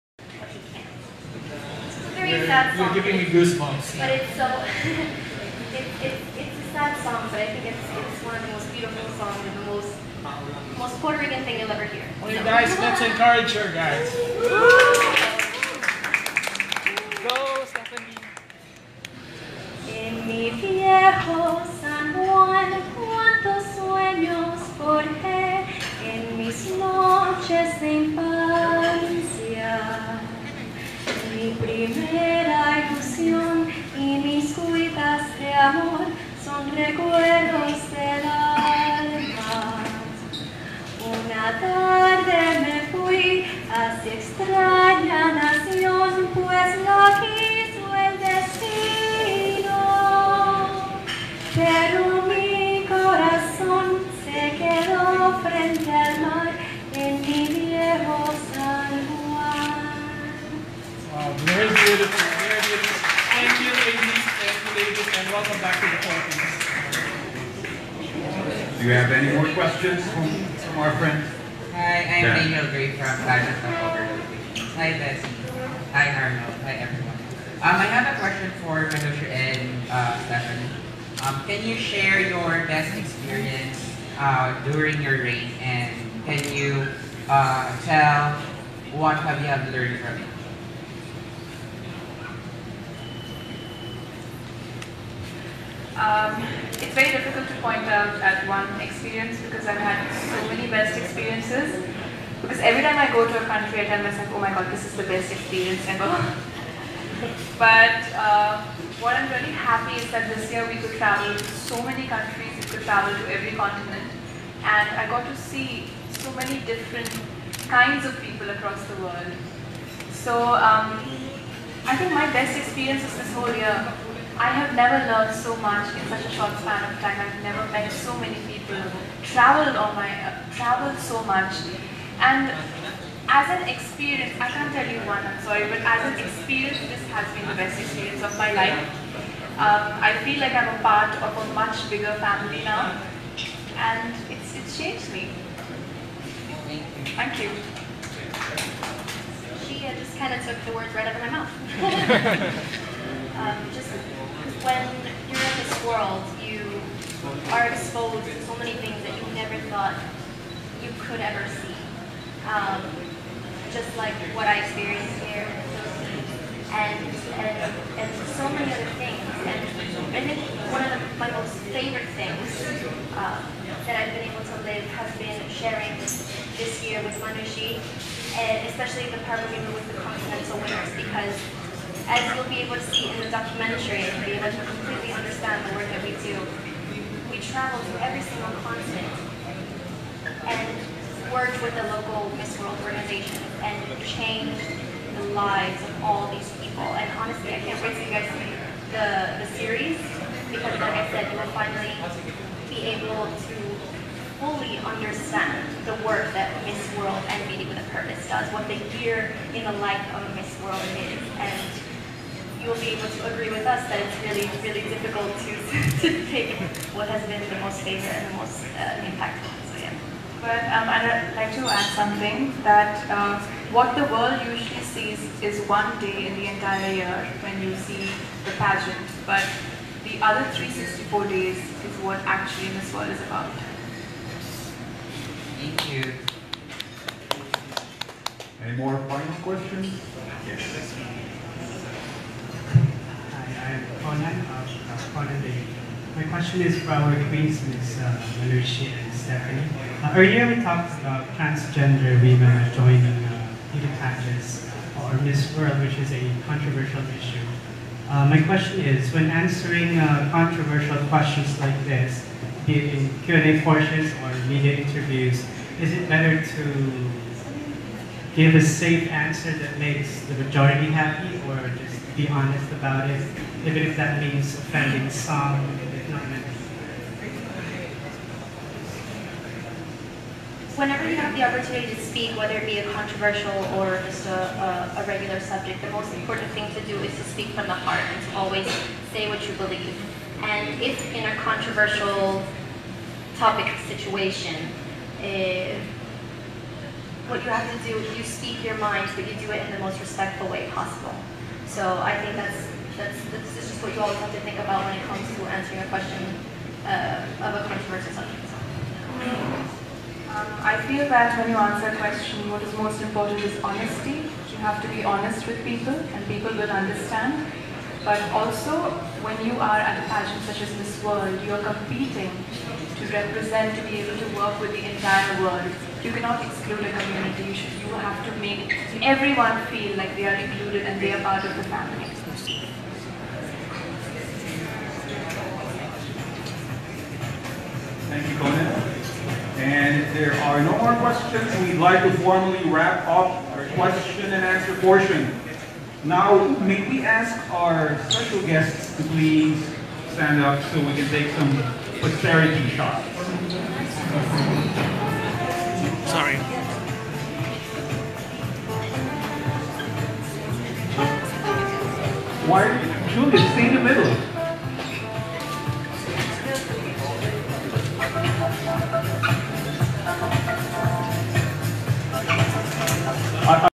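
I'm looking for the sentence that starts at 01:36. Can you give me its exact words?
Um, it's very difficult to point out at one experience because I've had so many best experiences.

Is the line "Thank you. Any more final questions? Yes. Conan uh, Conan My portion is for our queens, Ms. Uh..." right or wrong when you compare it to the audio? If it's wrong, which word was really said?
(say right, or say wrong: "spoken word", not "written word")
wrong: "question", not "portion".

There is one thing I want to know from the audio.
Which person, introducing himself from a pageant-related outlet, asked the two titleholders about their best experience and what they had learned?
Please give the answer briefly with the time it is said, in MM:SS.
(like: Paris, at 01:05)
Daniel Gray, at 01:12.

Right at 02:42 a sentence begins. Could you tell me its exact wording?
Um, just like what I experienced here in and, and, and so many other things.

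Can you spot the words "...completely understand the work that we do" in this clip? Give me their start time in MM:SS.
03:04.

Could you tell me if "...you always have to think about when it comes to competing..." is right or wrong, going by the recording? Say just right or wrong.
wrong.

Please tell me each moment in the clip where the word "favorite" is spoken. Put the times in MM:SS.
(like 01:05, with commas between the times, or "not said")
02:51, 03:37.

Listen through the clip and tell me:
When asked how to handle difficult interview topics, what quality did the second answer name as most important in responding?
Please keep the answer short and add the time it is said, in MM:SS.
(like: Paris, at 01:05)
Honesty, at 05:13.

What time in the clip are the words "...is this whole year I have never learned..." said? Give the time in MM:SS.
02:03.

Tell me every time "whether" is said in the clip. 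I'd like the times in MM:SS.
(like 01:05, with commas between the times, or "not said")
04:42.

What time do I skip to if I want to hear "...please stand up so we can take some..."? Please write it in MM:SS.
05:49.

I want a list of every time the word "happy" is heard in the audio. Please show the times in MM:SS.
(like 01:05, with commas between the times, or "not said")
01:49, 04:30.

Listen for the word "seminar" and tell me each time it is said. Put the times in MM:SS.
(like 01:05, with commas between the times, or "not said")
not said.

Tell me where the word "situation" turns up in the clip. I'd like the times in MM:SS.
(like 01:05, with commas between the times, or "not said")
04:53.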